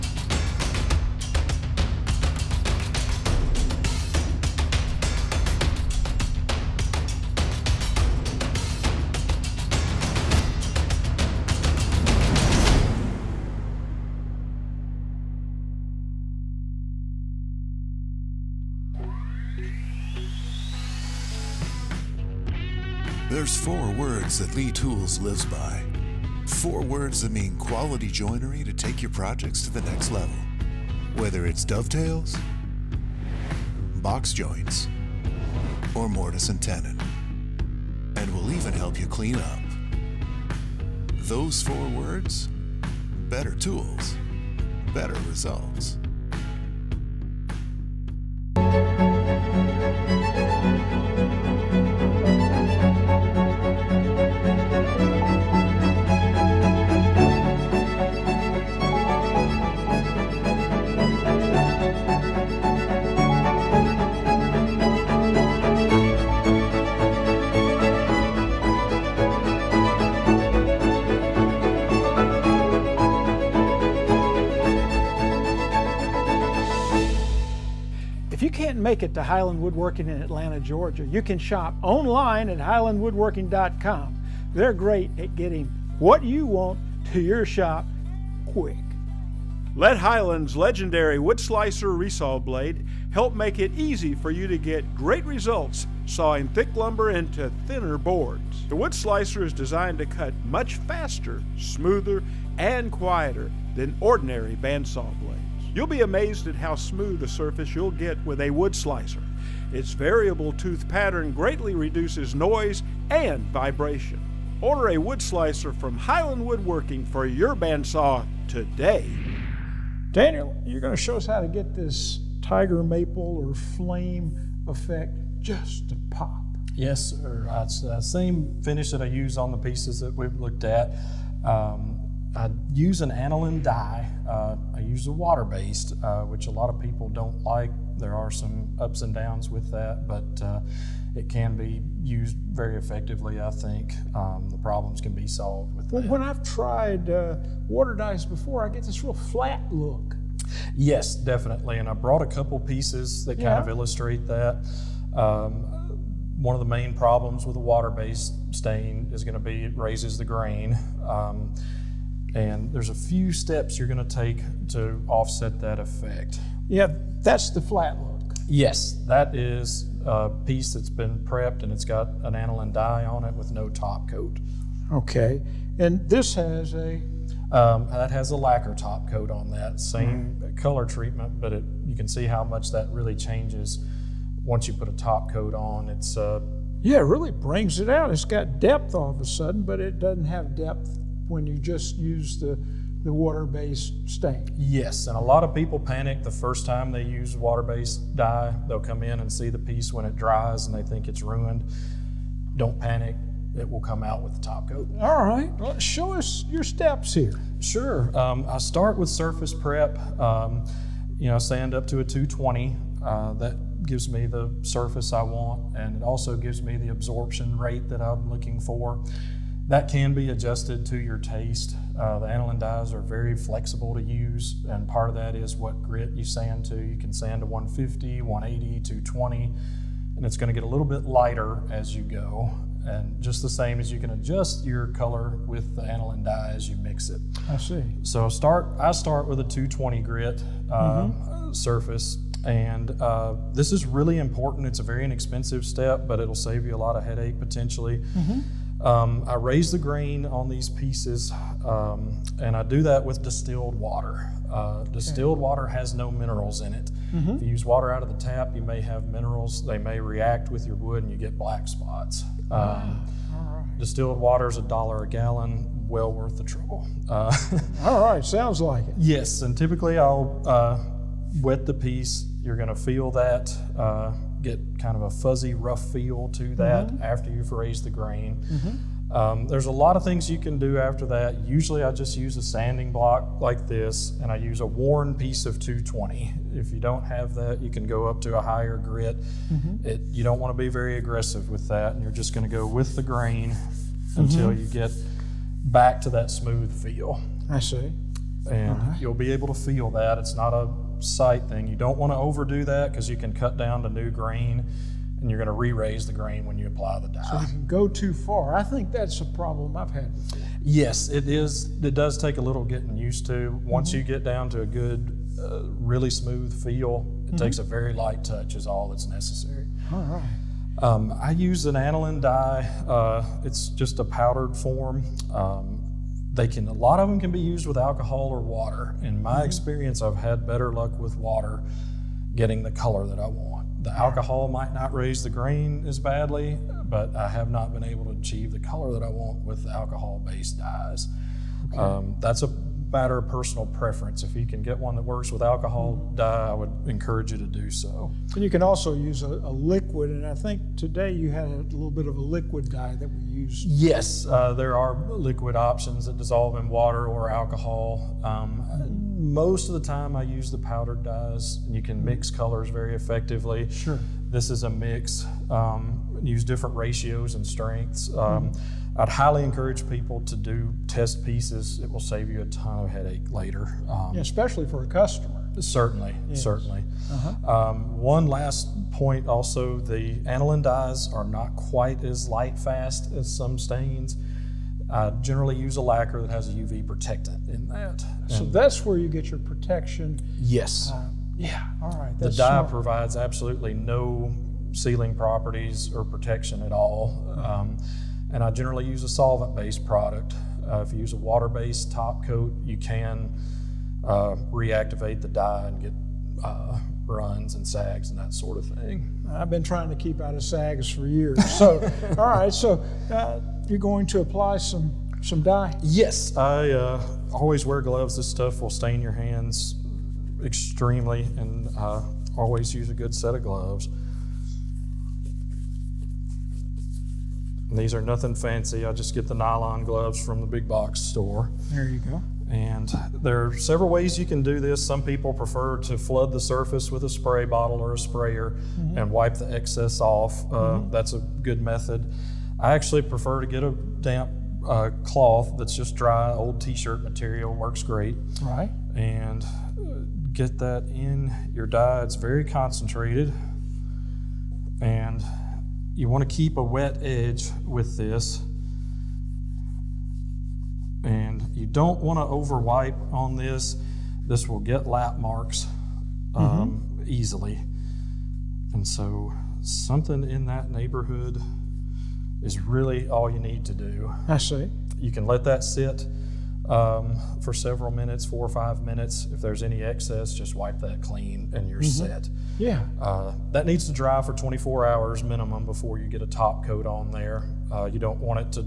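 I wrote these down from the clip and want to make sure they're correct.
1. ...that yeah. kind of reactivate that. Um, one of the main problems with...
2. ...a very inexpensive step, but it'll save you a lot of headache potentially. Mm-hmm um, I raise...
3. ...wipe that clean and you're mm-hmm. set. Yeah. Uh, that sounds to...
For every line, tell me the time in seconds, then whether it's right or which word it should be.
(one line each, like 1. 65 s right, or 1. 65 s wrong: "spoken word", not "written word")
1. 153 s wrong: "illustrate", not "reactivate"
2. 244 s right
3. 480 s wrong: "needs", not "sounds".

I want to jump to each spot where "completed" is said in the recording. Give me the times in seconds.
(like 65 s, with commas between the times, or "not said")
not said.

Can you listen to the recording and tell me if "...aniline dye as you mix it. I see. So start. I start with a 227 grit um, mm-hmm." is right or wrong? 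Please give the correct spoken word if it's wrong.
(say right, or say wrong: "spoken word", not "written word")
wrong: "220", not "227".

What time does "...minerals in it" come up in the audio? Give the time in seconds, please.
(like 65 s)
256 s.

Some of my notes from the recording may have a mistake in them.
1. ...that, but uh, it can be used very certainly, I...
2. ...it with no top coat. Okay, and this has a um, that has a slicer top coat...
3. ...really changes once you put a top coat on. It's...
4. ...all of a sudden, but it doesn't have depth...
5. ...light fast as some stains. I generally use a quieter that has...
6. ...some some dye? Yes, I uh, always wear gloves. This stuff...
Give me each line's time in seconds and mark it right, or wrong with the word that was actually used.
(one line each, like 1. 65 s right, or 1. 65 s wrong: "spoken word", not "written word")
1. 139 s wrong: "effectively", not "certainly"
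2. 173 s wrong: "lacquer", not "slicer"
3. 182 s right
4. 188 s right
5. 382 s wrong: "lacquer", not "quieter"
6. 414 s right.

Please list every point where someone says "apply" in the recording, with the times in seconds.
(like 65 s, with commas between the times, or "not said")
306 s, 414 s.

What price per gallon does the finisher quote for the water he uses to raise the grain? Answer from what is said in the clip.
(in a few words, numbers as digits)
A dollar.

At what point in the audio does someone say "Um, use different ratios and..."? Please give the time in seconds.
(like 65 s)
365 s.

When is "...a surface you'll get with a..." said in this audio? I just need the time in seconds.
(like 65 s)
107 s.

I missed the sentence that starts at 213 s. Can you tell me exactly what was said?
Uh, that gives me the surface I want, and it also gives me the absorption rate that I'm looking for.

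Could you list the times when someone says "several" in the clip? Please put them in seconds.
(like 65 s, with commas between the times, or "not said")
433 s, 477 s.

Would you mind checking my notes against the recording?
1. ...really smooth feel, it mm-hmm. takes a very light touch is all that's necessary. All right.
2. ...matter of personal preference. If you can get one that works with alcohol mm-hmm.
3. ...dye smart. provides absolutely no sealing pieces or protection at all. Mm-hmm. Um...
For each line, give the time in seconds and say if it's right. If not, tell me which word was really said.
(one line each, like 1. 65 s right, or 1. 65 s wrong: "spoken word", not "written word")
1. 315 s right
2. 342 s right
3. 392 s wrong: "properties", not "pieces".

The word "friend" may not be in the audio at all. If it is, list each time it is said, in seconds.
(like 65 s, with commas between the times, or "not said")
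not said.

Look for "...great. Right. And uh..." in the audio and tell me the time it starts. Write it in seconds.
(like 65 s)
447 s.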